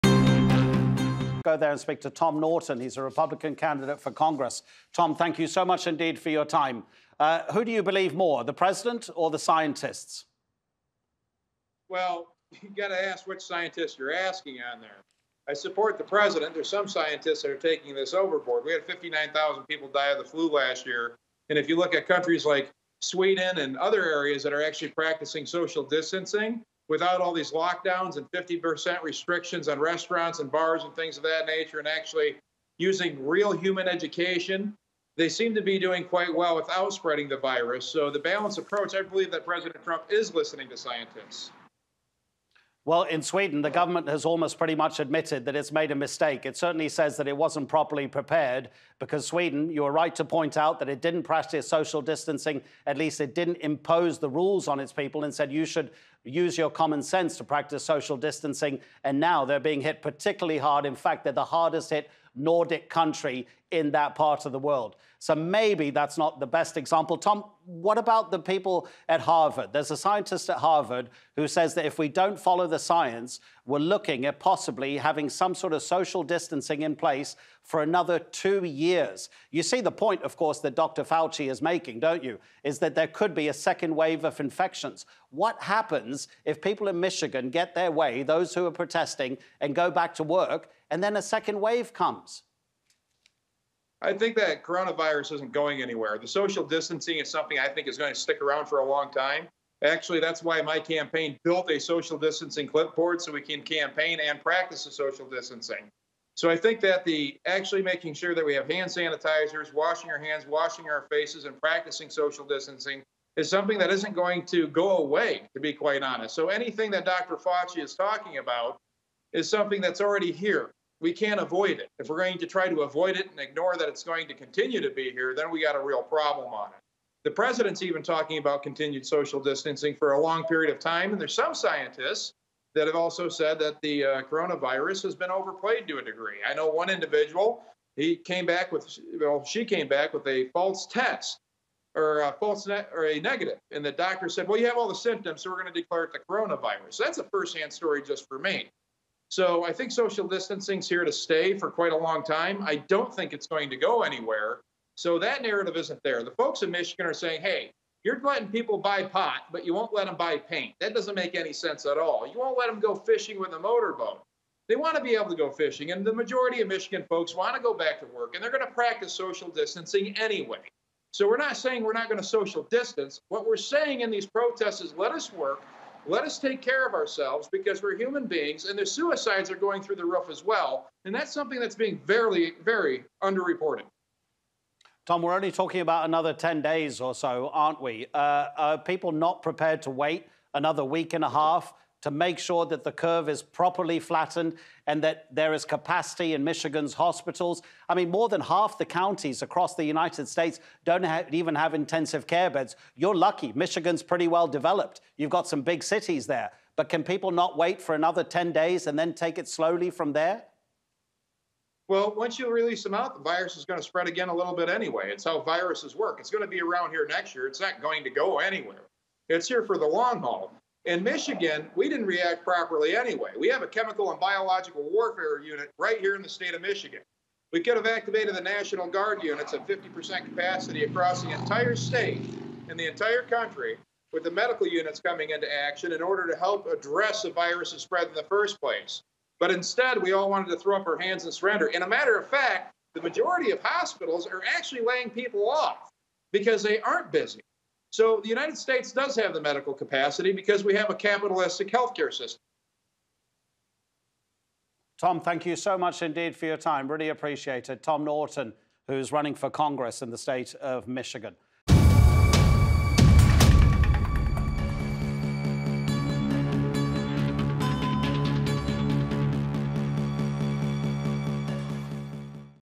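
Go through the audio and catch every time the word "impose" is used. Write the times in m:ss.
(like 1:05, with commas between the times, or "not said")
0:53.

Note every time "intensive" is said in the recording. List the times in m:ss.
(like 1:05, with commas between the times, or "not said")
3:21.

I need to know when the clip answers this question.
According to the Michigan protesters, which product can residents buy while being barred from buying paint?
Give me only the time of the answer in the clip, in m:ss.
2:39.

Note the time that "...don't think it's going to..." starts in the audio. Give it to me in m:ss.
2:32.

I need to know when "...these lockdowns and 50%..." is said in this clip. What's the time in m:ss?
0:27.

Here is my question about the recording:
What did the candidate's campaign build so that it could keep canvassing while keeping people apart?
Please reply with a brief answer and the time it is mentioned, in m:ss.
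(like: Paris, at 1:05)
social distancing clipboard, at 1:41.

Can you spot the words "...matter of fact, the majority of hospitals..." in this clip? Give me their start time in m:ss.
4:01.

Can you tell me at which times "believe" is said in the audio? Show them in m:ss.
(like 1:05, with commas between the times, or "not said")
0:07, 0:39.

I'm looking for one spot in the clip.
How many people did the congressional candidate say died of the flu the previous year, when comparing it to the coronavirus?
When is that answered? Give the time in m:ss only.
0:18.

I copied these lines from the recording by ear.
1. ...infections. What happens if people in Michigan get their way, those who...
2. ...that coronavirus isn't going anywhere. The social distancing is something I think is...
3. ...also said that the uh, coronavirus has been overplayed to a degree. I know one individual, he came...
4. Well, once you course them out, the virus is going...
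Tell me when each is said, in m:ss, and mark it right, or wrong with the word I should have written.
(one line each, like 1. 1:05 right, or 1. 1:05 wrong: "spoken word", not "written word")
1. 1:24 right
2. 1:34 right
3. 2:12 right
4. 3:31 wrong: "release", not "course".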